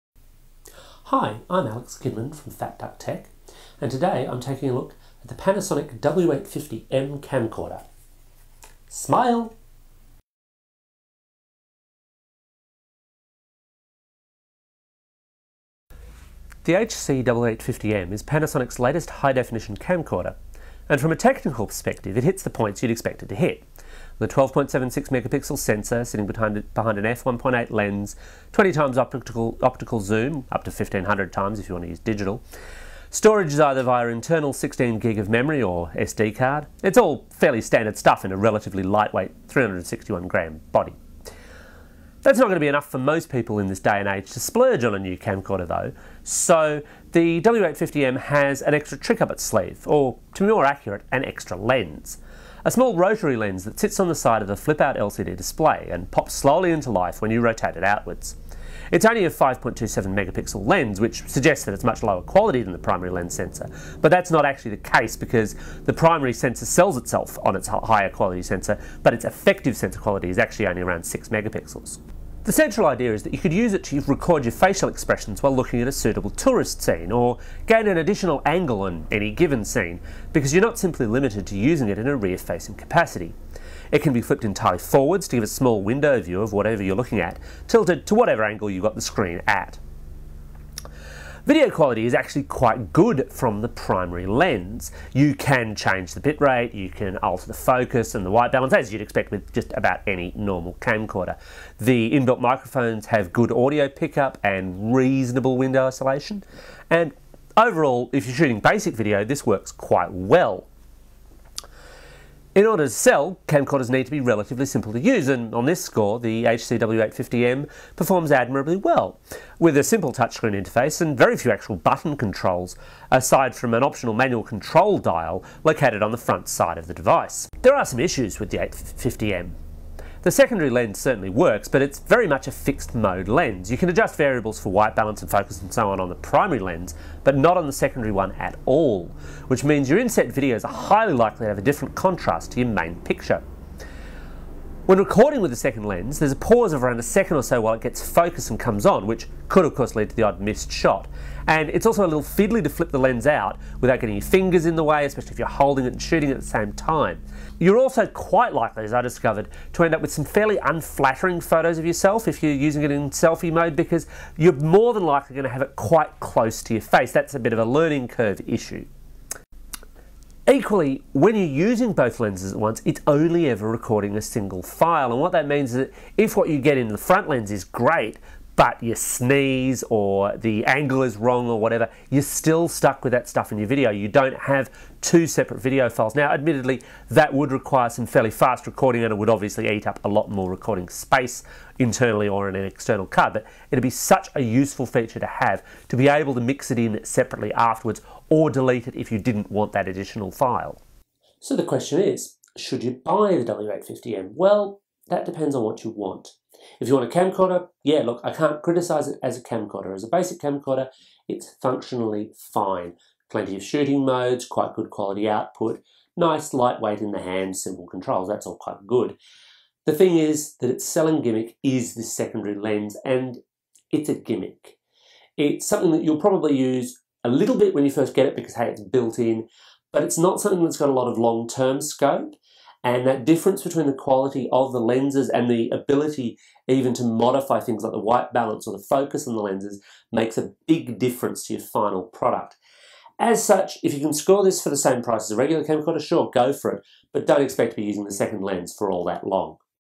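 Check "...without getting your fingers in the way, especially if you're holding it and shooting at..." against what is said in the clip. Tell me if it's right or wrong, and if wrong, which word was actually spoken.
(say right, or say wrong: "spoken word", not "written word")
right.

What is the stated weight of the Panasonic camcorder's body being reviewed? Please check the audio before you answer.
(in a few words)
361 grams.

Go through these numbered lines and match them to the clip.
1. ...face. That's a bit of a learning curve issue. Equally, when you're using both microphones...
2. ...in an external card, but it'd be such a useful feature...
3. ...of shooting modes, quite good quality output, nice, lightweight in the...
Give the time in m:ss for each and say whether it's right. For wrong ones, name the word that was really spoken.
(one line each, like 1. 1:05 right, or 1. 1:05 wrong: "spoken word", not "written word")
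1. 2:46 wrong: "lenses", not "microphones"
2. 3:12 right
3. 3:33 right.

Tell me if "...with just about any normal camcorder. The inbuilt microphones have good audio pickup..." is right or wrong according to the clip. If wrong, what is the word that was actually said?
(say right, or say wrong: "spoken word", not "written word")
right.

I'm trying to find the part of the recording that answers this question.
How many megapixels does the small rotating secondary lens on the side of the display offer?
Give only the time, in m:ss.
0:59.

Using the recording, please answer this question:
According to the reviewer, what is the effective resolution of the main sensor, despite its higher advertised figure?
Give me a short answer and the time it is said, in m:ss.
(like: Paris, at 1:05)
6 megapixels, at 1:11.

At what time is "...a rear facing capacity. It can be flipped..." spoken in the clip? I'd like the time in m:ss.
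1:22.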